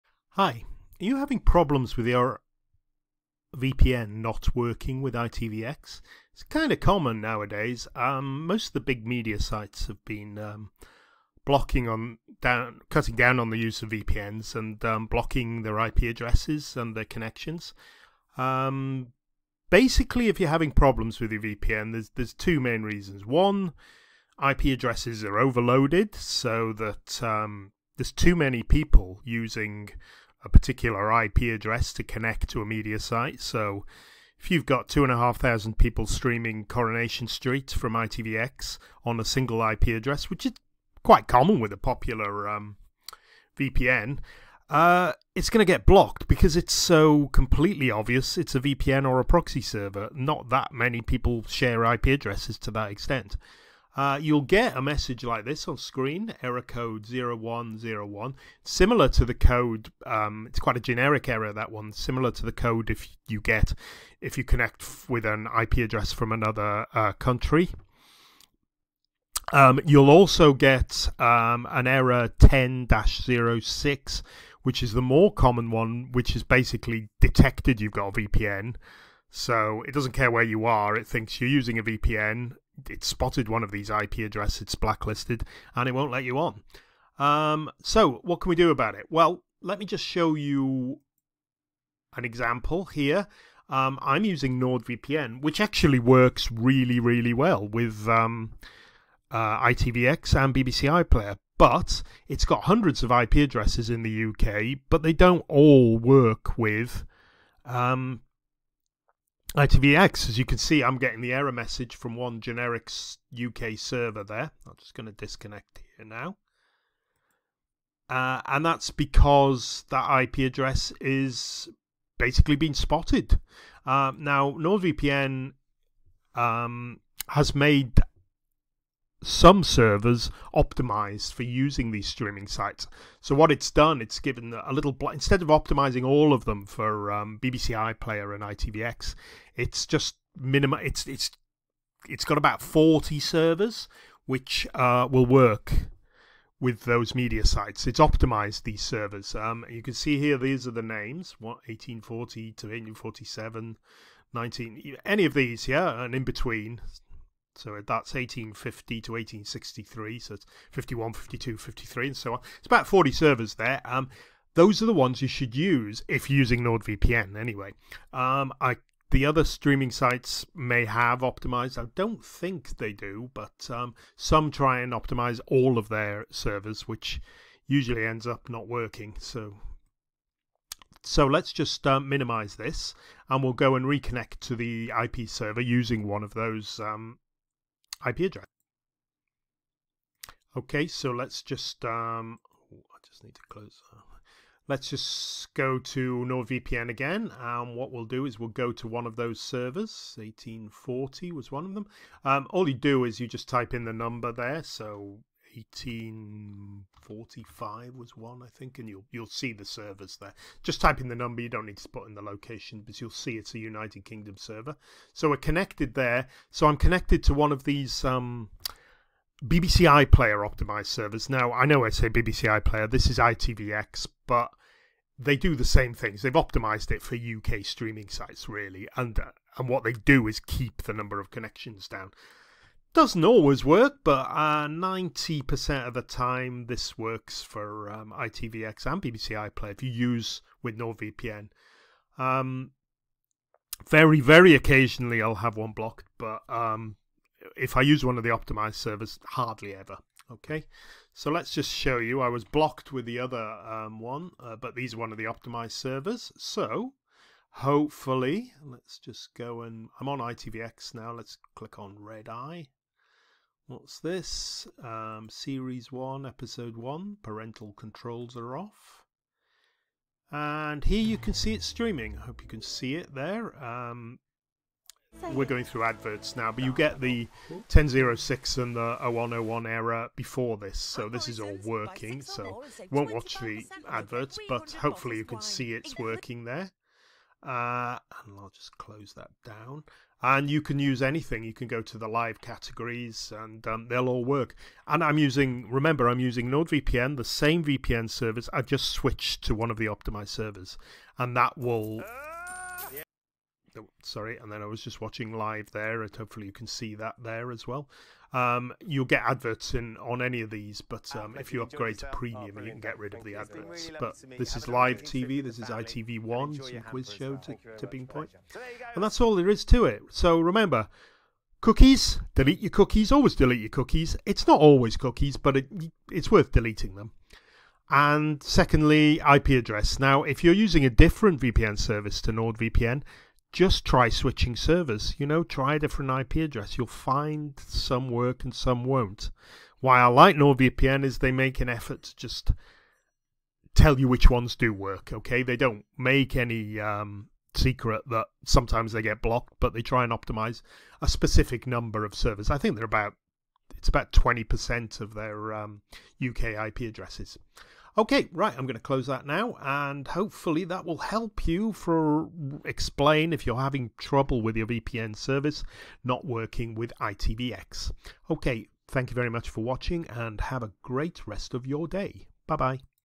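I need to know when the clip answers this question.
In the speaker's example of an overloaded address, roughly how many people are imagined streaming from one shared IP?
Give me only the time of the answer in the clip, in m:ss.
0:34.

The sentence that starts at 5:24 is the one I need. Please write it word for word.
It's not always cookies, but it, it's worth deleting them and secondly, IP address.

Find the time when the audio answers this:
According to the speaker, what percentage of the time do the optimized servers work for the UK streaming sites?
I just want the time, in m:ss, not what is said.
3:54.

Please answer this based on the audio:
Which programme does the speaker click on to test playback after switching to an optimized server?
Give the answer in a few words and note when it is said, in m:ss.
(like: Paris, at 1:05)
Red Eye, at 4:21.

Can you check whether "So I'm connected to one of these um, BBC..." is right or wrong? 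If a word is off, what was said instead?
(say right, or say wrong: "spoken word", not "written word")
right.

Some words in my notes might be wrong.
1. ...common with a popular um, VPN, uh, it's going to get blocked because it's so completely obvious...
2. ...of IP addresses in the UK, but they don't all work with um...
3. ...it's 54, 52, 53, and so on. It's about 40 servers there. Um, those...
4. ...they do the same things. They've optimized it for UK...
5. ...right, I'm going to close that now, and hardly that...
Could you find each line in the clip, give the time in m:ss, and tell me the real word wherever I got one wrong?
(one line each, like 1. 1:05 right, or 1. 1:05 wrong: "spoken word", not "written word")
1. 0:41 right
2. 1:43 right
3. 2:40 wrong: "51", not "54"
4. 3:45 right
5. 5:58 wrong: "hopefully", not "hardly".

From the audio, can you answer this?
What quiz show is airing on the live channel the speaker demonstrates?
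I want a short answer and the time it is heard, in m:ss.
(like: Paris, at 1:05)
Tipping Point, at 5:17.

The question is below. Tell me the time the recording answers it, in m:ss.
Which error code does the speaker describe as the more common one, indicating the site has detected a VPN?
1:12.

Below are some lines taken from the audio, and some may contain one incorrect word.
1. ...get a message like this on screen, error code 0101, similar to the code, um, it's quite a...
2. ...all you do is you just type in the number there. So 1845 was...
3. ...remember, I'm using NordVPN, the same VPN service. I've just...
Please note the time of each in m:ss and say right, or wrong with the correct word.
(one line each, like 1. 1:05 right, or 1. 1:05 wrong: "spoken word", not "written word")
1. 0:54 right
2. 3:22 right
3. 4:55 right.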